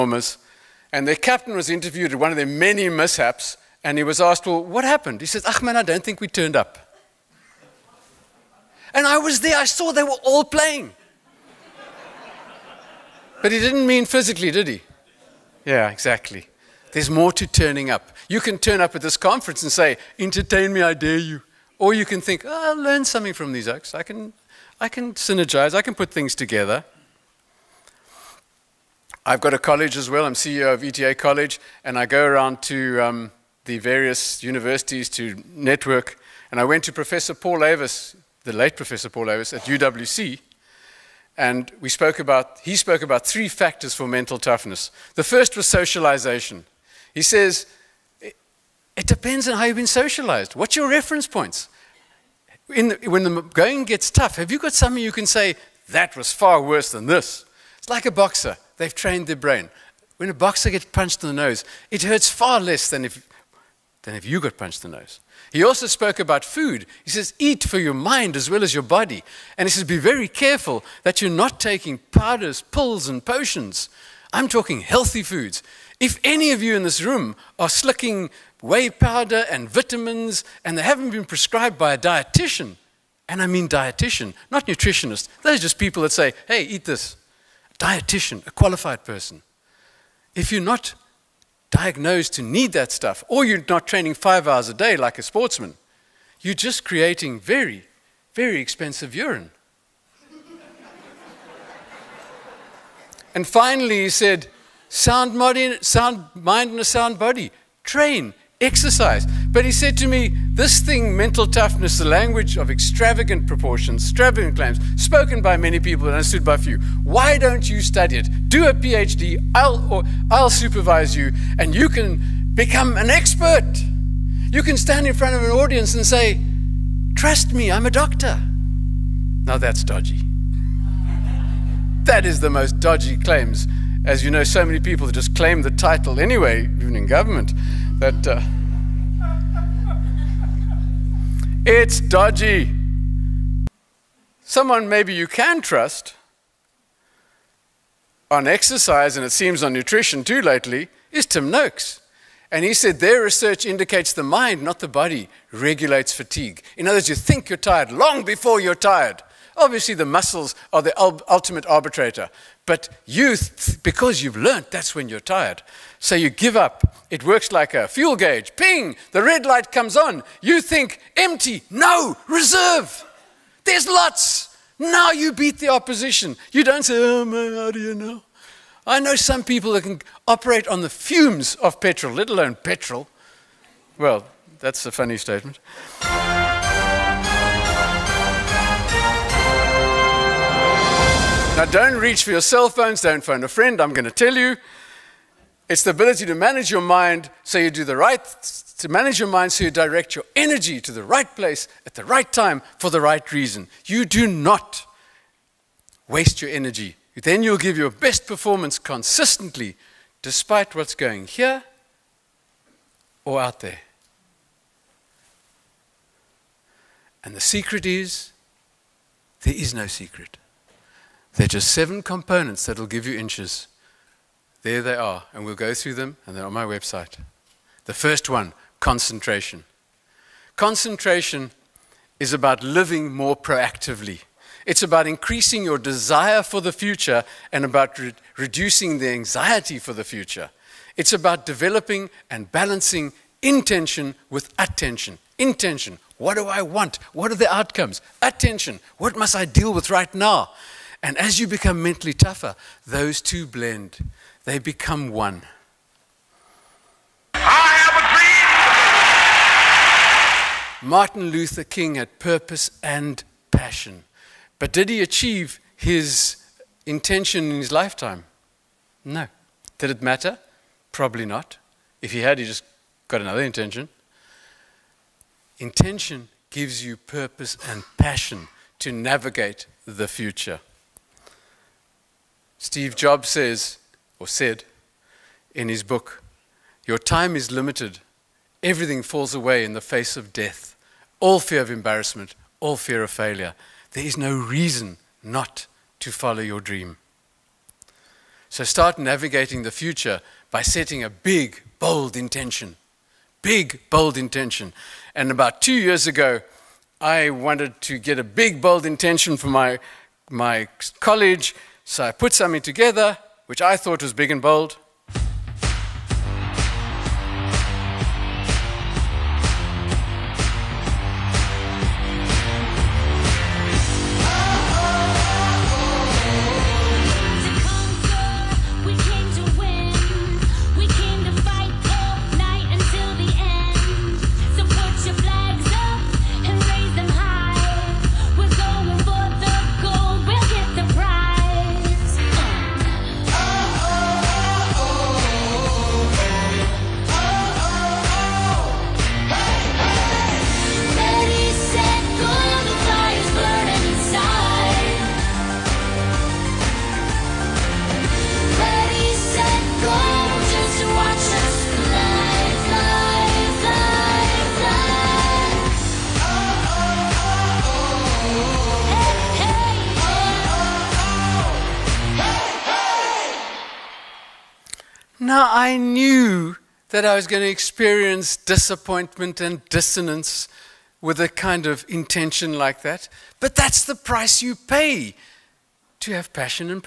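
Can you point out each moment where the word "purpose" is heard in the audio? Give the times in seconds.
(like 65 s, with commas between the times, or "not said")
262 s, 276 s.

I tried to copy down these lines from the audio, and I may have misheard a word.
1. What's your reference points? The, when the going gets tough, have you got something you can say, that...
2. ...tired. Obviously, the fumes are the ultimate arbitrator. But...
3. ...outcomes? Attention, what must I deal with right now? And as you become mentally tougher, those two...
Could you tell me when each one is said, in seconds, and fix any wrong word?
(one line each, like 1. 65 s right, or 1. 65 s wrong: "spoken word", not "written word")
1. 50 s right
2. 158 s wrong: "muscles", not "fumes"
3. 247 s right.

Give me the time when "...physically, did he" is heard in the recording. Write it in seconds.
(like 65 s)
14 s.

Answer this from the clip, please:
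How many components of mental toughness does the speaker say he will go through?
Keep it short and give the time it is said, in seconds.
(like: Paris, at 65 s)
7, at 221 s.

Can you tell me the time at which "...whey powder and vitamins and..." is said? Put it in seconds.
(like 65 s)
78 s.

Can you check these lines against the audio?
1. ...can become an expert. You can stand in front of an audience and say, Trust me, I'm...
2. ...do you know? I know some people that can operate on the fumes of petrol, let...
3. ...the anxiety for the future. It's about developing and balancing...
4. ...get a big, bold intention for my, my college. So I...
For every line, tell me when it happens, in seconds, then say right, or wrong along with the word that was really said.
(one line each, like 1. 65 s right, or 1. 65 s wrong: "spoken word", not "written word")
1. 121 s right
2. 177 s right
3. 238 s right
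4. 307 s right.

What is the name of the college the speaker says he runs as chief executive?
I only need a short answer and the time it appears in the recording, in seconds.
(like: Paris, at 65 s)
ETA College, at 30 s.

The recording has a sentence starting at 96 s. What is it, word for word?
You're just creating very, very expensive urine.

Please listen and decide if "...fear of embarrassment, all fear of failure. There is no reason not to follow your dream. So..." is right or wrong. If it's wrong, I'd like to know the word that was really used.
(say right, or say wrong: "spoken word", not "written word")
right.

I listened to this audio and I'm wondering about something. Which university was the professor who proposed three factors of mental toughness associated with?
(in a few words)
UWC.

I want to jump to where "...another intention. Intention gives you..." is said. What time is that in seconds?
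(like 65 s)
273 s.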